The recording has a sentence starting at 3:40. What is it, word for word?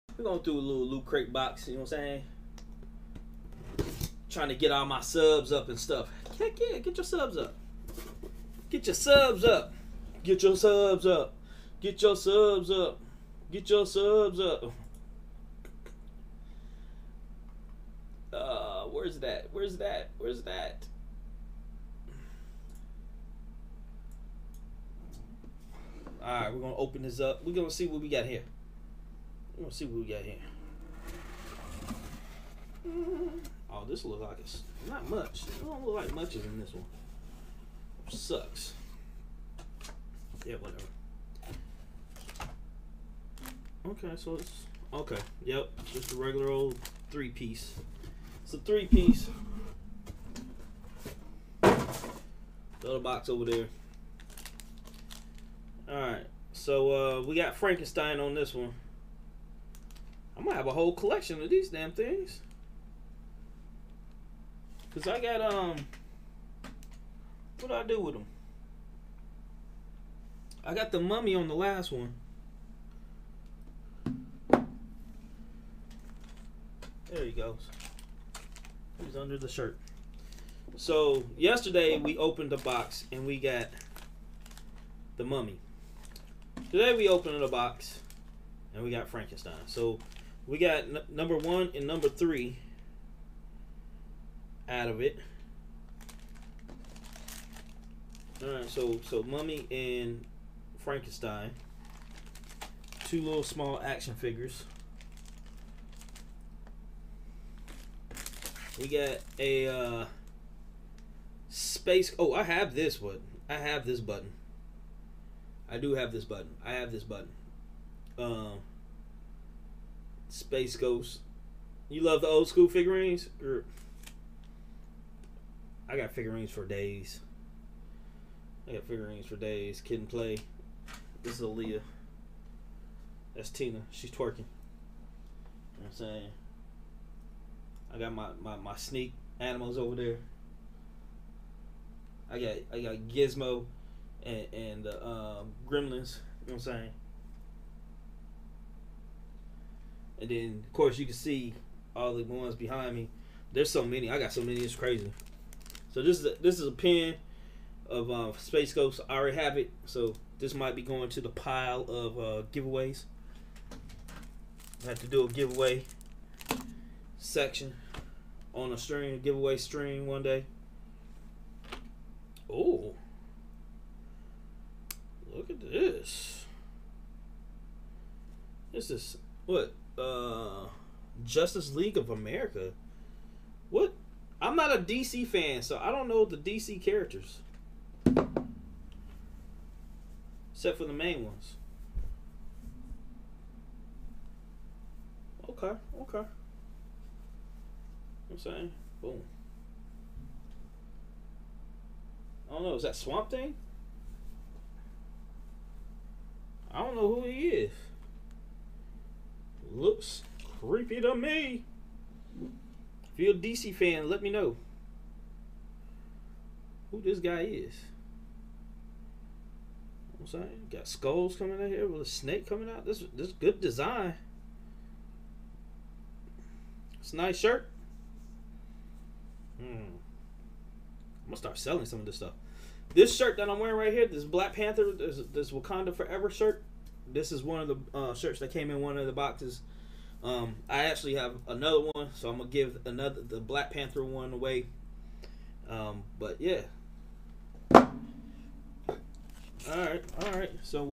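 I'm saying, got skulls coming out here with a snake coming out.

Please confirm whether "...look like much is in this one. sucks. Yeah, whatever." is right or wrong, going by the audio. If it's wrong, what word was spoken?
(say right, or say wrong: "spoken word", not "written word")
right.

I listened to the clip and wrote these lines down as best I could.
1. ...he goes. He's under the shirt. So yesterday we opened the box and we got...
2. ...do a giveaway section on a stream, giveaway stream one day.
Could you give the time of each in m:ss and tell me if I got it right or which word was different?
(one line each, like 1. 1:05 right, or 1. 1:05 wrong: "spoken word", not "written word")
1. 1:17 right
2. 2:45 right.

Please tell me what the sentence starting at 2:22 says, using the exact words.
I got I got Gizmo and, and the uh, um, Gremlins.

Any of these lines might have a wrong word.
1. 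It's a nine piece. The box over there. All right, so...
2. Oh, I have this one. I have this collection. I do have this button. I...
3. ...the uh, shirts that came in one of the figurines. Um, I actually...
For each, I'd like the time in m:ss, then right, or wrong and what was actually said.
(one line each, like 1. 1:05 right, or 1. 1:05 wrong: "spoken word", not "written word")
1. 0:48 wrong: "three", not "nine"
2. 1:52 wrong: "button", not "collection"
3. 3:57 wrong: "boxes", not "figurines".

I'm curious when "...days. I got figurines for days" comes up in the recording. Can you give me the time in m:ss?
2:06.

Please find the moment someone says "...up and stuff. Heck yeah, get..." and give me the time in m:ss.
0:05.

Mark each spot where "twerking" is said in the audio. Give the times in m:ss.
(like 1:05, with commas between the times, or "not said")
2:14.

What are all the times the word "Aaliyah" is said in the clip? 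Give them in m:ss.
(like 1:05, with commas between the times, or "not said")
2:11.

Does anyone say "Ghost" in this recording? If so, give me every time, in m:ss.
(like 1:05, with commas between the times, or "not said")
2:00, 2:38.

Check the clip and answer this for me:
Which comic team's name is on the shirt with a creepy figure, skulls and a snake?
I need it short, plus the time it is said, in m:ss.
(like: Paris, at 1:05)
Justice League of America, at 3:01.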